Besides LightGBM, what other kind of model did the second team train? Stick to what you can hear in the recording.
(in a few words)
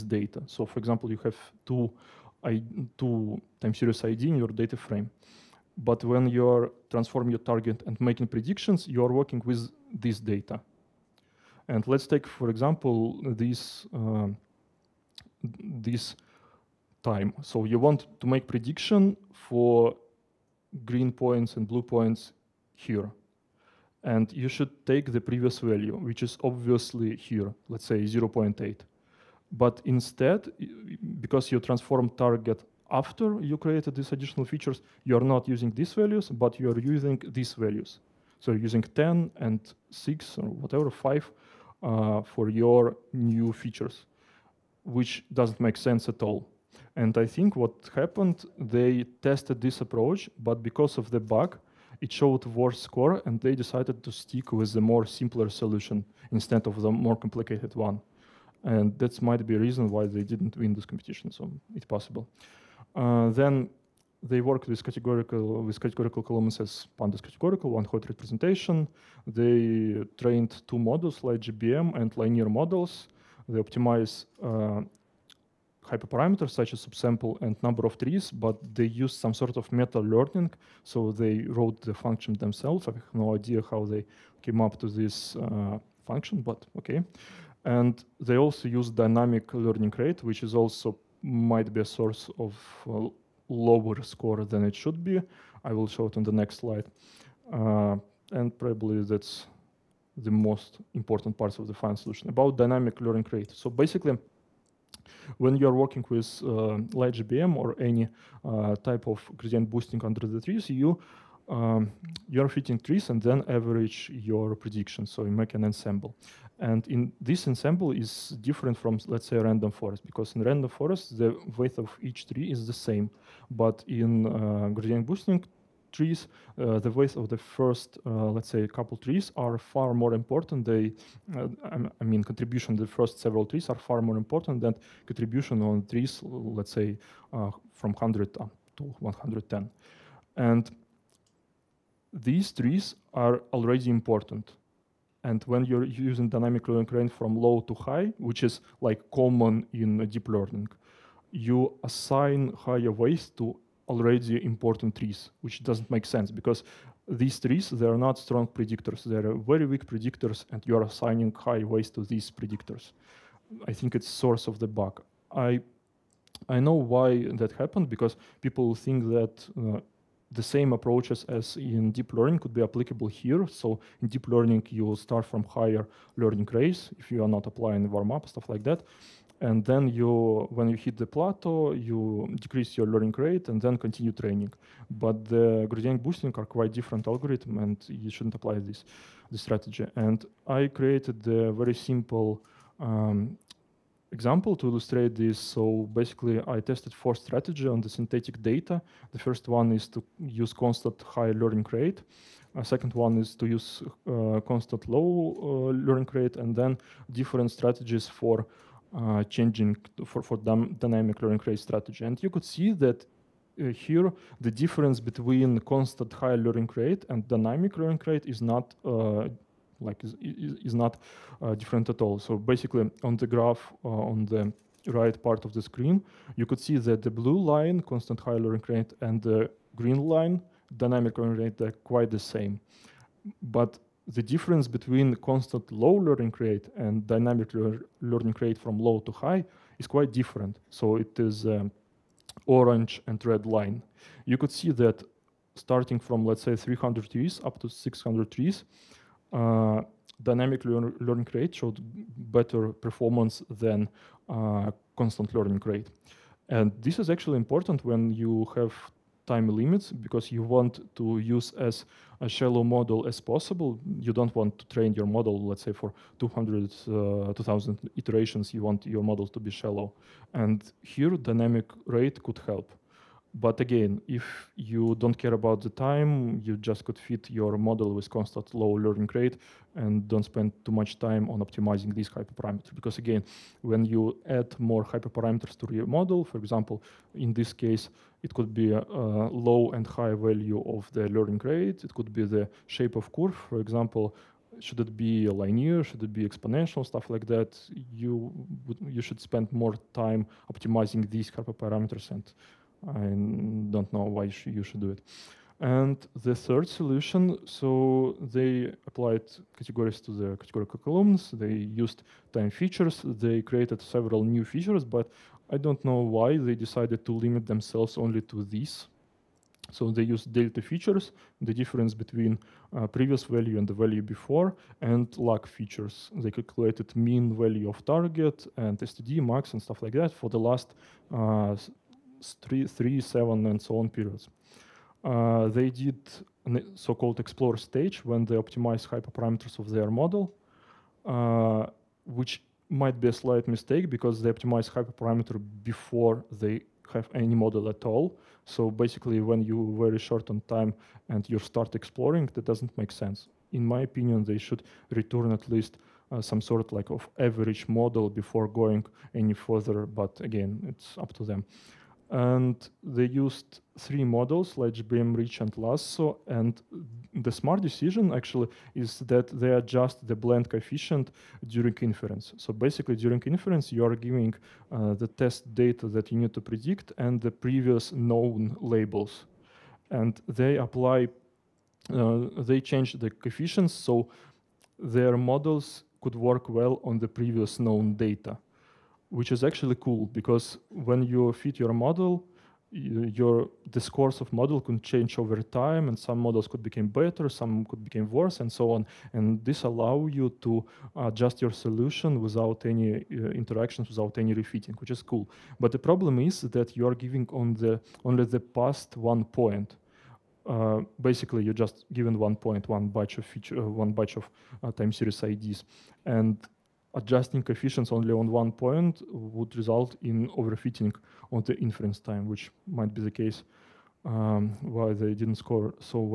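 linear models.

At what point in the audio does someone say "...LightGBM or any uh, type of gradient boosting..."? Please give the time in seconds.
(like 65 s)
106 s.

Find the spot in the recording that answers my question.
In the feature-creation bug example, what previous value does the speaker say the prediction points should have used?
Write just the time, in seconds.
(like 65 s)
28 s.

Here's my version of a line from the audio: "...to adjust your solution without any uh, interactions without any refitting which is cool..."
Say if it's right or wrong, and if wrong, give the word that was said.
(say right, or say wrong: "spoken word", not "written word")
right.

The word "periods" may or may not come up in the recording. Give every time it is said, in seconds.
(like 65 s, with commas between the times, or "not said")
333 s.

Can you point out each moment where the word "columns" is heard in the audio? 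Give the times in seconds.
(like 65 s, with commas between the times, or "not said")
66 s, 310 s.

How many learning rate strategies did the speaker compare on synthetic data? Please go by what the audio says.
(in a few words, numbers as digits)
4.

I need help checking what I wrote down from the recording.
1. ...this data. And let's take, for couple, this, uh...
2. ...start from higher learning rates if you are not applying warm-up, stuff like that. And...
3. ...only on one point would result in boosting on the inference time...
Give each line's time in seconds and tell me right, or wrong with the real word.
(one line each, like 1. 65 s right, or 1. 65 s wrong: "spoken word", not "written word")
1. 9 s wrong: "example", not "couple"
2. 174 s right
3. 417 s wrong: "overfitting", not "boosting".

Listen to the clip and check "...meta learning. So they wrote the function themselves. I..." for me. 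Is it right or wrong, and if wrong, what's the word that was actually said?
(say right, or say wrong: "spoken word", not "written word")
right.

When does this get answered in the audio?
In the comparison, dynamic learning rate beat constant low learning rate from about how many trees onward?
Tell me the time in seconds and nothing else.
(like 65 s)
246 s.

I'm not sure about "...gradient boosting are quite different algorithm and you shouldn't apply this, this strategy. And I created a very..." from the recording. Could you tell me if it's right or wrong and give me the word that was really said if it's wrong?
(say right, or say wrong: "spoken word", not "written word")
right.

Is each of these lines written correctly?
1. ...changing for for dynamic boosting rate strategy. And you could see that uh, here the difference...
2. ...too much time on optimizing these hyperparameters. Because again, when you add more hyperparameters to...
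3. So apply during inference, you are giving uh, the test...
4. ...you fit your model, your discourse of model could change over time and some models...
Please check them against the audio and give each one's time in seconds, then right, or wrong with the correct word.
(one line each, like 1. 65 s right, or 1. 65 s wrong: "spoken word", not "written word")
1. 209 s wrong: "learning", not "boosting"
2. 280 s right
3. 372 s wrong: "basically", not "apply"
4. 391 s right.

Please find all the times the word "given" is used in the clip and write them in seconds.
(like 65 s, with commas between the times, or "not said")
411 s.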